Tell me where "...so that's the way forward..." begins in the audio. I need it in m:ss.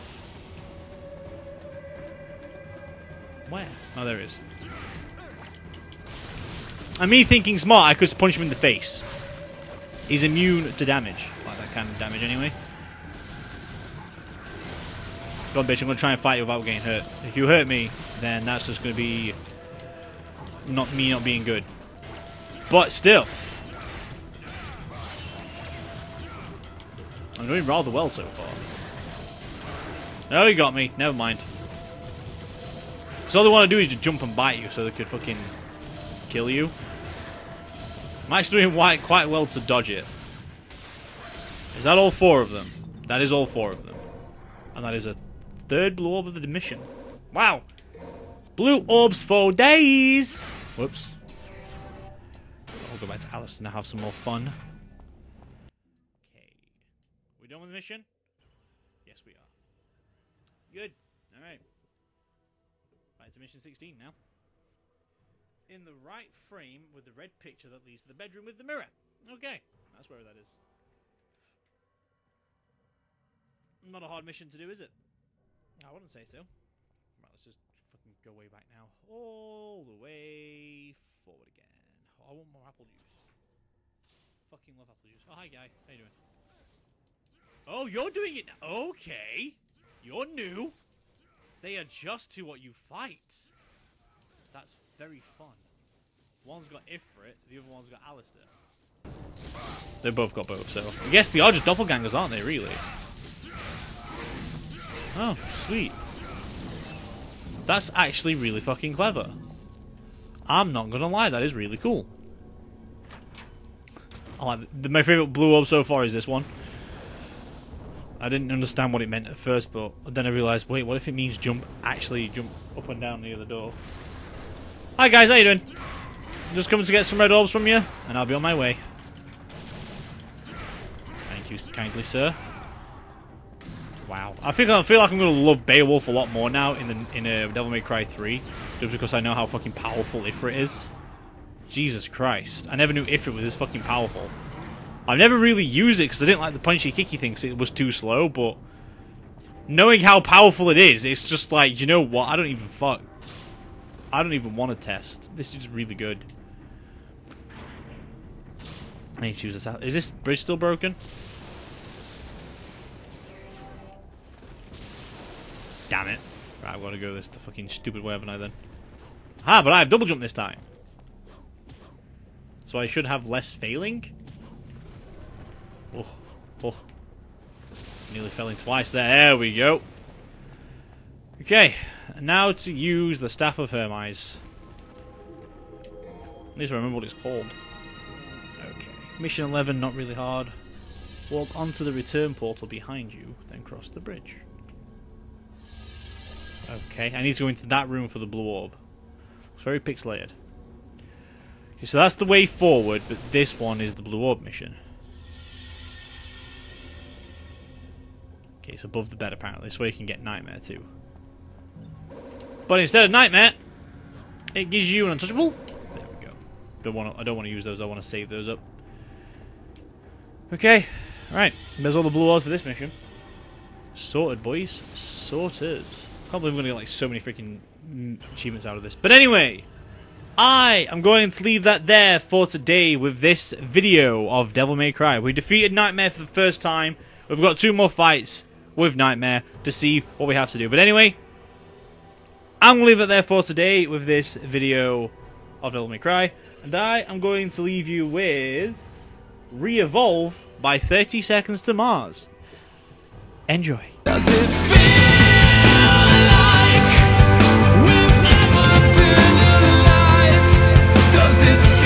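3:21.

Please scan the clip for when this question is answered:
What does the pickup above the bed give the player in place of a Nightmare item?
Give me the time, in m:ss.
3:35.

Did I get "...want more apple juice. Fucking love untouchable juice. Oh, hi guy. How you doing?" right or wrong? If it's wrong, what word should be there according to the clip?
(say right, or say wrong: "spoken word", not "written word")
wrong: "apple", not "untouchable".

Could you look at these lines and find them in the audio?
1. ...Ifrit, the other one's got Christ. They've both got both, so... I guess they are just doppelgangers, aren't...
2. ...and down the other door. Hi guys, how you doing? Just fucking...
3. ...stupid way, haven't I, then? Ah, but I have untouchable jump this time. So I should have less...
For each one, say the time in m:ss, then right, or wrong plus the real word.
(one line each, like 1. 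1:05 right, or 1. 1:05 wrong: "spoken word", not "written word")
1. 1:36 wrong: "Alastor", not "Christ"
2. 2:02 wrong: "coming", not "fucking"
3. 2:47 wrong: "double", not "untouchable".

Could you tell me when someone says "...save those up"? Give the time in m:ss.
3:38.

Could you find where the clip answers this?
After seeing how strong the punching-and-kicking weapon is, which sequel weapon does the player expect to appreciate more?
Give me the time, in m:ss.
2:15.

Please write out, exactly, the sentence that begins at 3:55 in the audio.
We defeated Nightmare for the first time.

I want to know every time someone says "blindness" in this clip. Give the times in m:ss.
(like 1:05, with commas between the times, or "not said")
not said.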